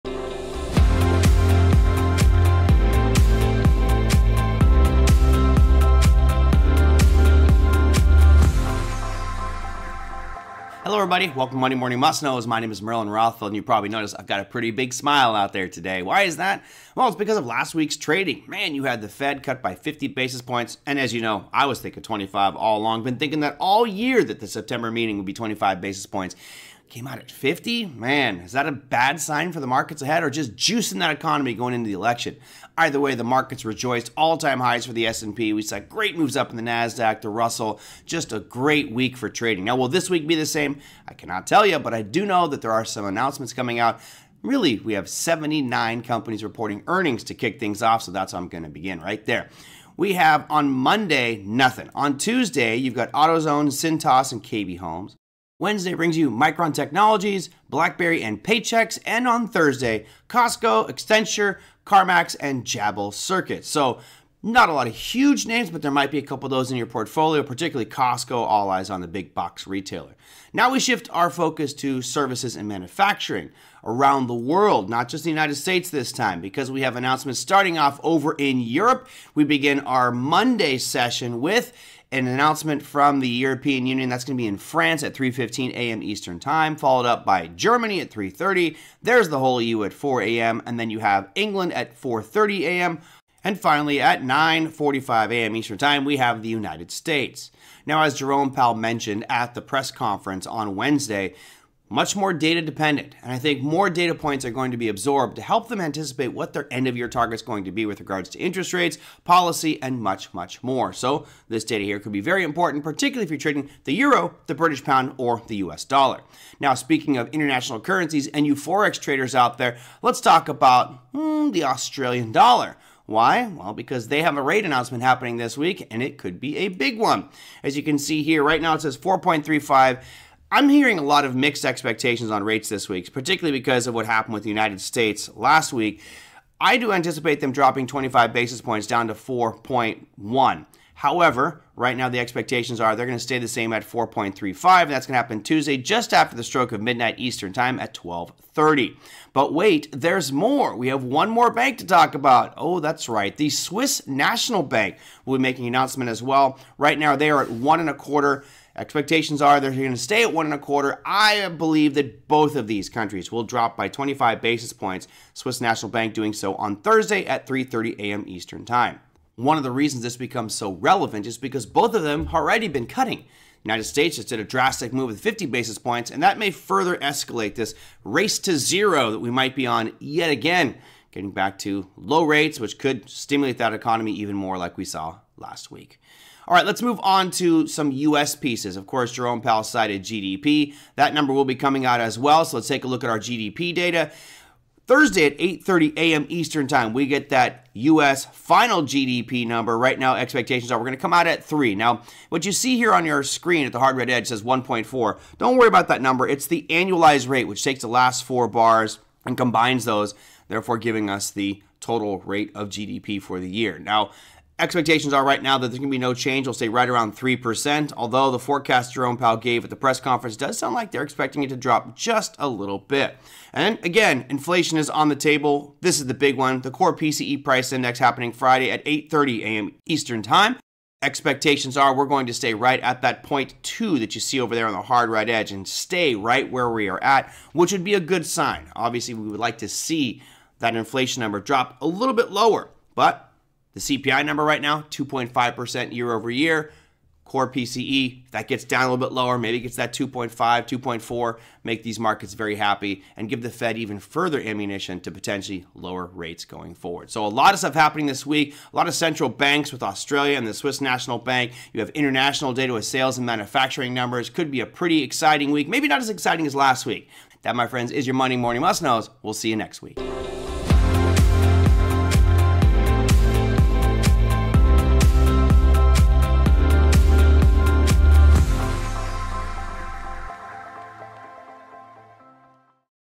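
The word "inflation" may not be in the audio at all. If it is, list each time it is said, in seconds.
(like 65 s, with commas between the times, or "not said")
224 s, 240 s.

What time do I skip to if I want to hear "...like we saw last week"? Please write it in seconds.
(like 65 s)
184 s.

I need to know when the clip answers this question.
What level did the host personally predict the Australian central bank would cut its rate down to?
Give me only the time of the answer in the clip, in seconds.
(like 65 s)
139 s.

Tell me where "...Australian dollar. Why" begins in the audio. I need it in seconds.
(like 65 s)
121 s.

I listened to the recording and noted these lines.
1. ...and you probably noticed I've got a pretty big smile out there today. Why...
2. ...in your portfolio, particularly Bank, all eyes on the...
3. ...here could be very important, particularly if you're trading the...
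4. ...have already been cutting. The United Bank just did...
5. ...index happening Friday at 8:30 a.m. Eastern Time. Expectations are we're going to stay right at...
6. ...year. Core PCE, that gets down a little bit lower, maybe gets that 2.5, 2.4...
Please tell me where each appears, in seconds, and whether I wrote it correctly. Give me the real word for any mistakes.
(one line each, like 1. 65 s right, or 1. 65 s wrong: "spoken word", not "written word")
1. 13 s right
2. 66 s wrong: "Costco", not "Bank"
3. 111 s right
4. 172 s wrong: "States", not "Bank"
5. 227 s right
6. 246 s right.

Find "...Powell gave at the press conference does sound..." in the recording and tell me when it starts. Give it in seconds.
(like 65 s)
219 s.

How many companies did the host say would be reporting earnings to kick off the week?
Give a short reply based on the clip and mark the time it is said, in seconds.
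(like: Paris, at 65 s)
79, at 45 s.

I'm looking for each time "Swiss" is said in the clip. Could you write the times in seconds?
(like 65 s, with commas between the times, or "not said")
153 s, 165 s, 260 s.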